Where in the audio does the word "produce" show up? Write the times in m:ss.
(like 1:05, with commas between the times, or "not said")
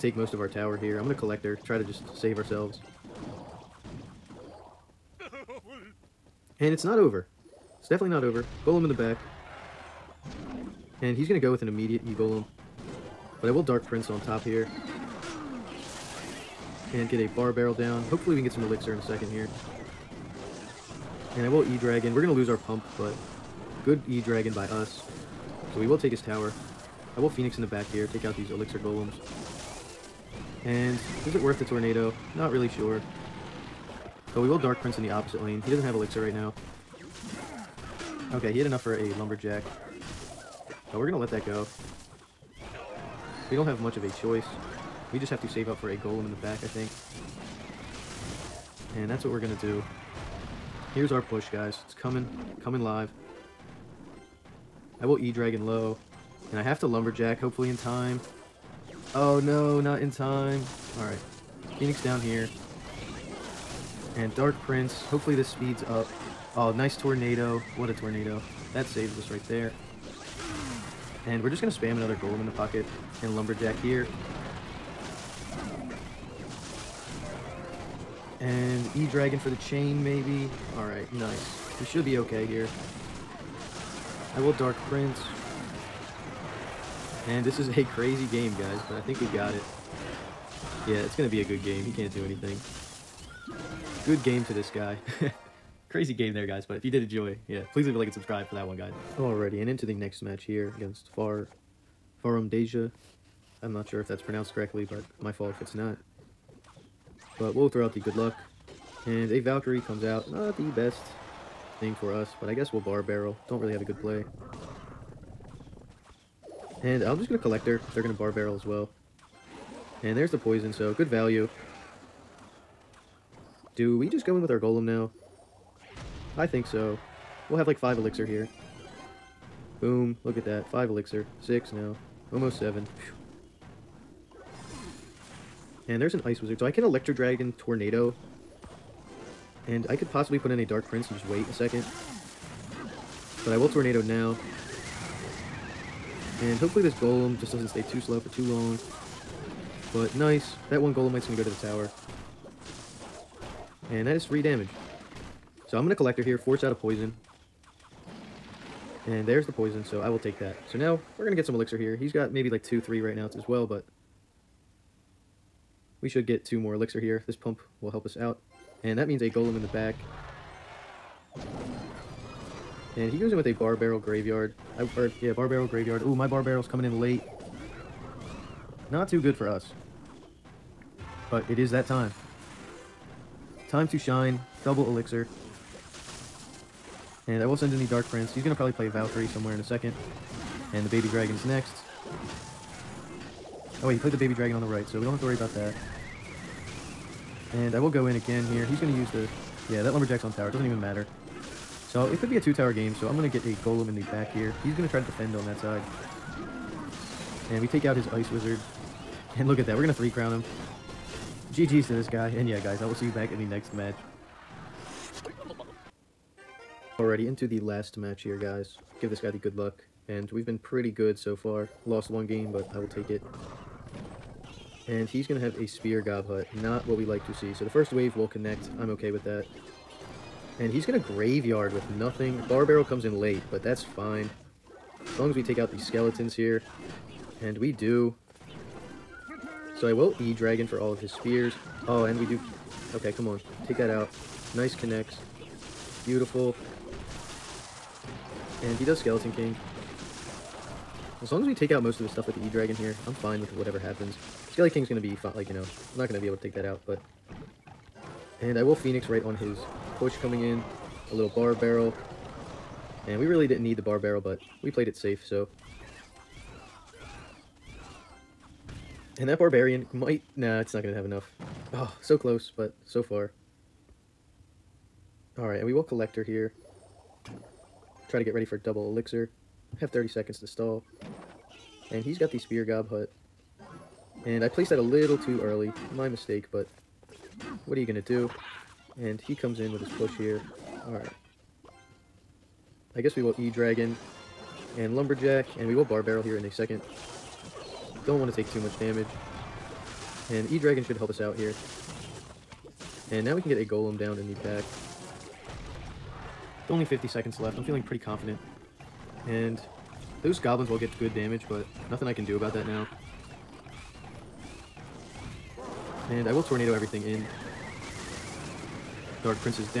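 not said.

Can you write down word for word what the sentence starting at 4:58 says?
Don't want to take too much damage.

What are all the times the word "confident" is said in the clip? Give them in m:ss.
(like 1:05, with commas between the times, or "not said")
5:07.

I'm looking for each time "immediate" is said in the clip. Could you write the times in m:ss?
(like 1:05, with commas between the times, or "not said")
0:11.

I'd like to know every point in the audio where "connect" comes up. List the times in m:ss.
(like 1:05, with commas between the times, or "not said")
3:48, 4:04.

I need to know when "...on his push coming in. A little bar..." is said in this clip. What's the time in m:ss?
4:19.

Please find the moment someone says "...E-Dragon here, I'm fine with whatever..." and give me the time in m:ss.
4:12.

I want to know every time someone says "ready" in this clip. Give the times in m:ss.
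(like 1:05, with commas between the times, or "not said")
4:38.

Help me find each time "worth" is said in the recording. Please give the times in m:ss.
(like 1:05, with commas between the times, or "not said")
0:31.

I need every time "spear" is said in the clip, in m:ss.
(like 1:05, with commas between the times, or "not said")
3:45, 4:01, 4:42.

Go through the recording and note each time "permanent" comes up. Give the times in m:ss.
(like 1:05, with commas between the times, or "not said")
not said.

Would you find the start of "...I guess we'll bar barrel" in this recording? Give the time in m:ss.
1:52.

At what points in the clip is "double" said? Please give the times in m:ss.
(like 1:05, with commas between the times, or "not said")
3:04, 4:38.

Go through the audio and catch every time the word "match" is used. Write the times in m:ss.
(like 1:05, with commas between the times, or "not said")
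1:40, 3:33, 3:37.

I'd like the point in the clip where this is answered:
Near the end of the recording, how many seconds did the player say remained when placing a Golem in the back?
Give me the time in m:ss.
5:06.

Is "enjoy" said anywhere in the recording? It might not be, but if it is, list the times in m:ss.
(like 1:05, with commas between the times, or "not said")
1:37.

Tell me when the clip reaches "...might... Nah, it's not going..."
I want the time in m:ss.
4:29.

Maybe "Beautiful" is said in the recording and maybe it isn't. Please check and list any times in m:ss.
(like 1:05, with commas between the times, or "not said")
4:06.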